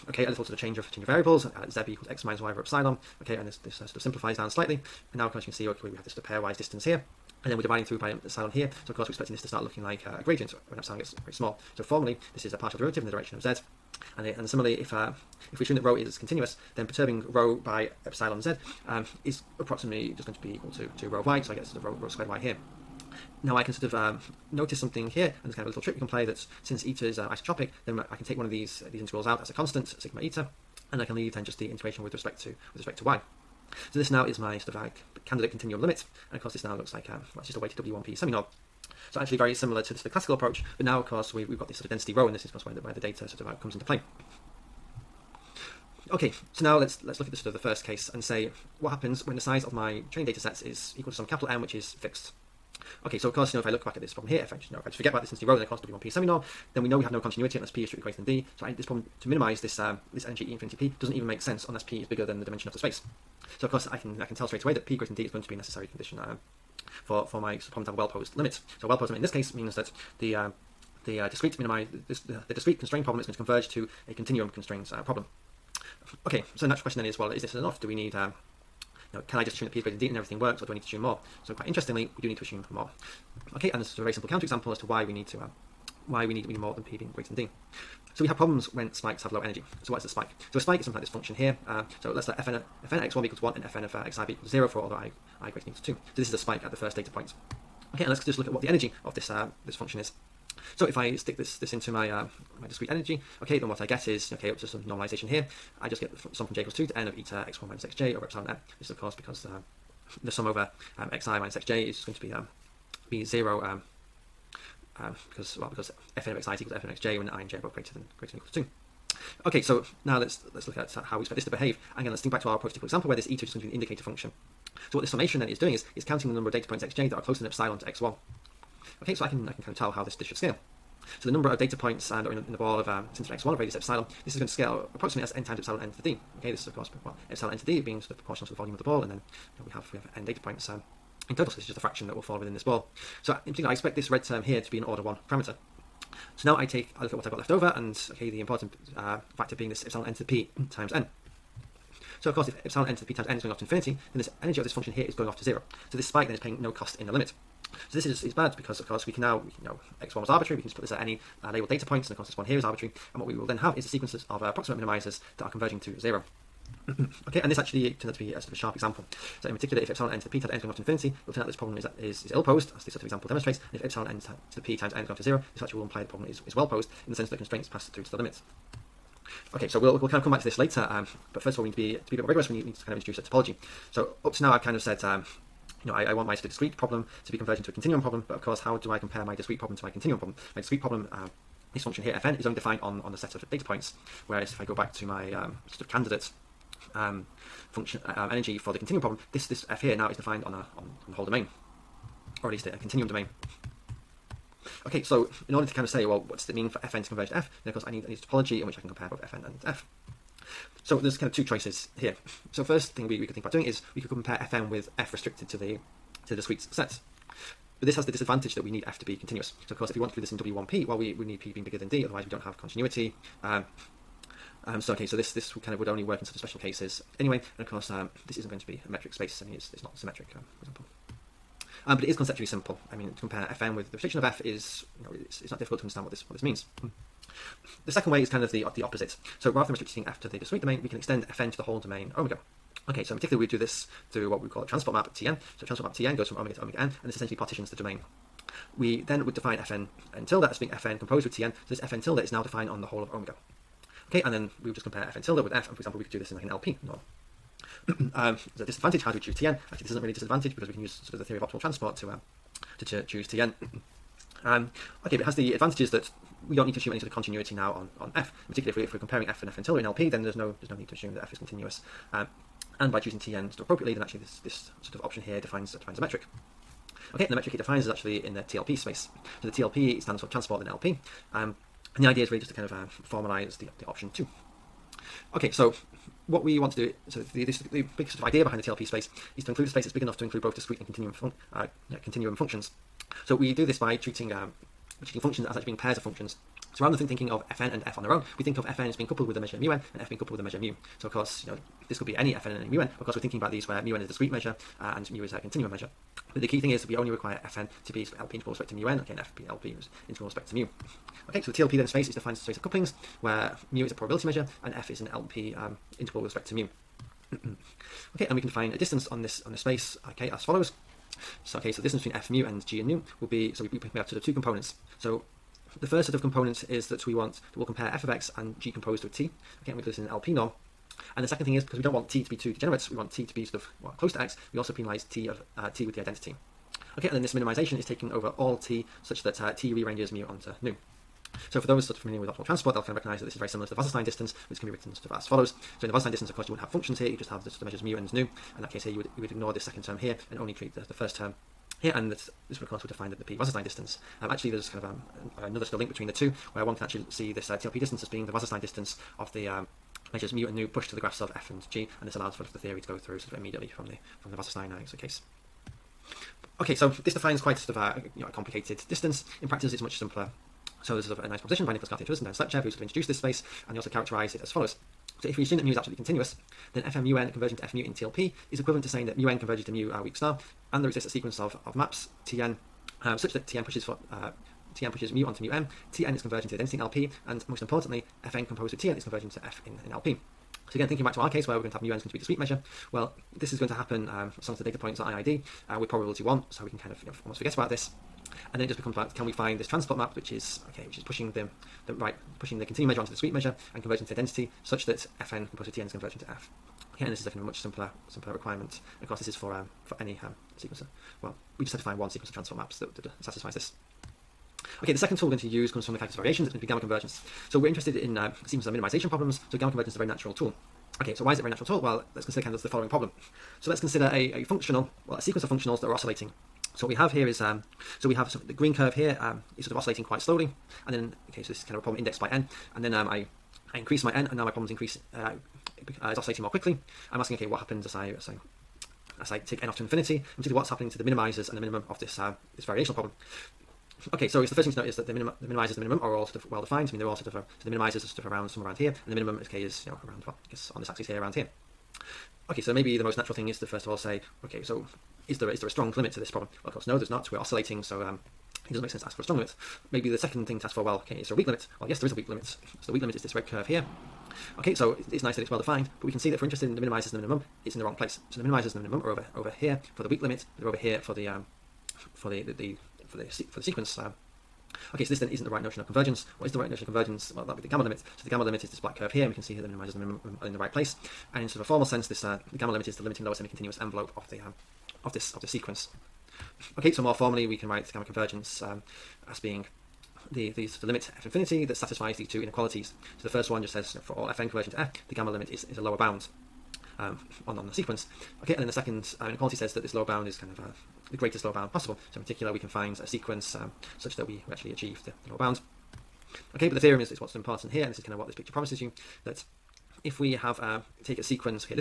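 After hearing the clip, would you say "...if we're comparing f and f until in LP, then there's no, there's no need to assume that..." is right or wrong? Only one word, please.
right.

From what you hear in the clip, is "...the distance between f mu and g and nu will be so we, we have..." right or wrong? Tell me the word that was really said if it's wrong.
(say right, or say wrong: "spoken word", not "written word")
right.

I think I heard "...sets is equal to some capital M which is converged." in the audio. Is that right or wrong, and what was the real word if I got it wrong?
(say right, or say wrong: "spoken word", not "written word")
wrong: "fixed", not "converged".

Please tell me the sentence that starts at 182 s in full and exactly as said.
We need, need to kind of introduce a topology.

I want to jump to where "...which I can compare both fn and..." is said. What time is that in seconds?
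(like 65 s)
208 s.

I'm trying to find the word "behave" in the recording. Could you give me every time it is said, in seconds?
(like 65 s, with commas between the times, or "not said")
121 s.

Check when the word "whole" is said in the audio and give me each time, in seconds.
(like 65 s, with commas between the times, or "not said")
201 s, 241 s, 252 s.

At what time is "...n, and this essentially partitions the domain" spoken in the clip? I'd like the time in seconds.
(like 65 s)
246 s.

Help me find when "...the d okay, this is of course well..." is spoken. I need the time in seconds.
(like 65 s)
135 s.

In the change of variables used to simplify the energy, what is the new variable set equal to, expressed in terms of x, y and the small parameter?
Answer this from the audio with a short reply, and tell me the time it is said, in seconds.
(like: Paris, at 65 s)
x minus y over epsilon, at 2 s.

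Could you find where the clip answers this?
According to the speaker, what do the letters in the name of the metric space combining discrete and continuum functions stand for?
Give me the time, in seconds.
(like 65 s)
280 s.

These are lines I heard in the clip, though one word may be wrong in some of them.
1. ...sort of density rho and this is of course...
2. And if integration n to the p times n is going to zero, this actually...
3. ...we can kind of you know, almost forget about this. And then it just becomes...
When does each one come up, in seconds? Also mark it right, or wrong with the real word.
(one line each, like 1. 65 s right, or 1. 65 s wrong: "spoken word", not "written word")
1. 41 s right
2. 173 s wrong: "epsilon", not "integration"
3. 396 s right.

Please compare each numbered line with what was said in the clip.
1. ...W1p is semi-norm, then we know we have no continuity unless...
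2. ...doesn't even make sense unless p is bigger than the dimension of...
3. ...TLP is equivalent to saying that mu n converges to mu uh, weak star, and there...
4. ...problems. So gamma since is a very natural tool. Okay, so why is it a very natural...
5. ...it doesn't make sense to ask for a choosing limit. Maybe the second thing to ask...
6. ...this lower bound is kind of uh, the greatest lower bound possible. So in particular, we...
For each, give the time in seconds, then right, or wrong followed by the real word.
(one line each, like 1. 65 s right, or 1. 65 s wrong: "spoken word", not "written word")
1. 55 s right
2. 61 s right
3. 377 s right
4. 419 s wrong: "convergence", not "since"
5. 458 s wrong: "strong", not "choosing"
6. 499 s right.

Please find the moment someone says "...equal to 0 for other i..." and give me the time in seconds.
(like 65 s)
94 s.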